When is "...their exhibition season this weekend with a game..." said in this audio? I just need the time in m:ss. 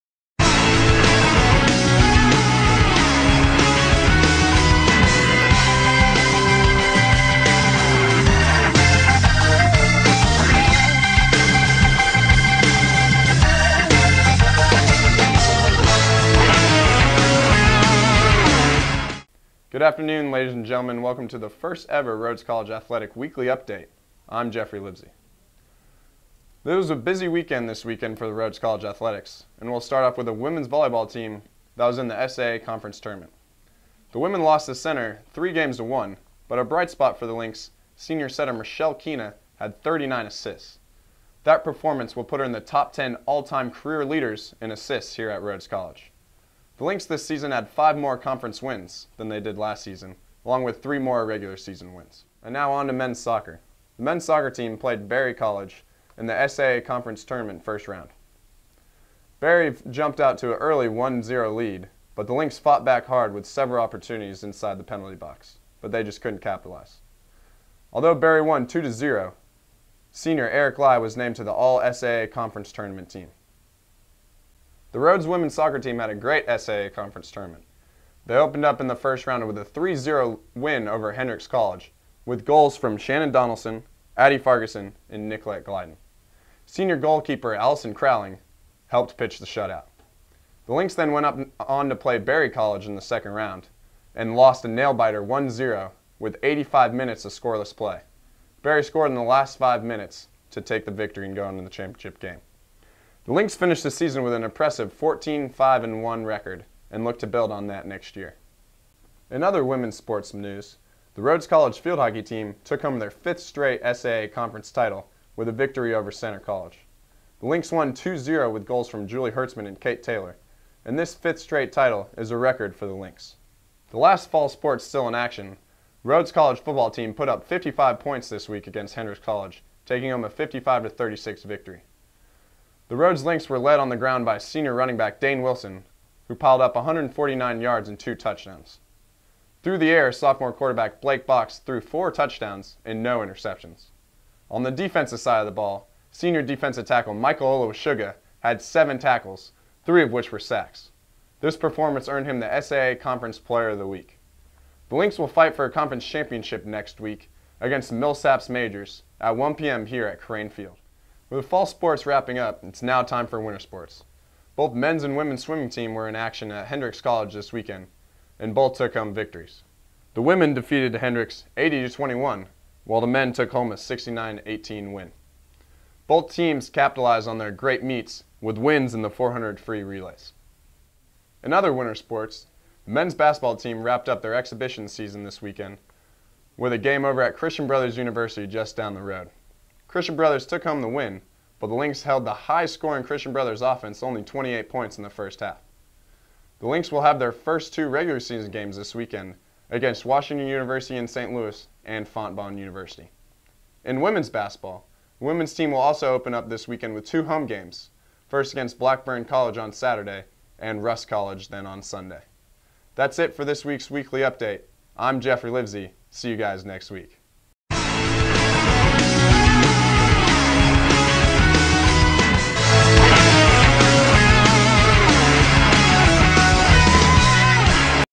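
3:04.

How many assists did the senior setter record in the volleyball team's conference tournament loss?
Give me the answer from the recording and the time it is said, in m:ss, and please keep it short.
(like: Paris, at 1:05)
39, at 0:39.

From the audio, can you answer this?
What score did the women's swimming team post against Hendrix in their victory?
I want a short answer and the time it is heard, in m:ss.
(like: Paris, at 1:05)
80-21, at 2:51.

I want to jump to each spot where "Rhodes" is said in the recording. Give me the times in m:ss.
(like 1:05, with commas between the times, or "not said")
0:22, 0:28, 0:45, 1:14, 1:51, 2:06, 2:12.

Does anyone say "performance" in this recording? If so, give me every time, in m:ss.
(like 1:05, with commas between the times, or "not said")
0:41, 2:31.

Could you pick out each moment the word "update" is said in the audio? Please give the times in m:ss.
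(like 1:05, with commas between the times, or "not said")
0:23, 3:34.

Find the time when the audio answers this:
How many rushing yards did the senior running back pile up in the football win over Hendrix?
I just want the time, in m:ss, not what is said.
2:16.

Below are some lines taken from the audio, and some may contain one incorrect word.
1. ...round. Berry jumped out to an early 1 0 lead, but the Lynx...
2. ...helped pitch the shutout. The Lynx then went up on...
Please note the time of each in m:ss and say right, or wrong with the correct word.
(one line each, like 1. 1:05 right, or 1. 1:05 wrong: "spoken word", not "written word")
1. 0:57 right
2. 1:28 right.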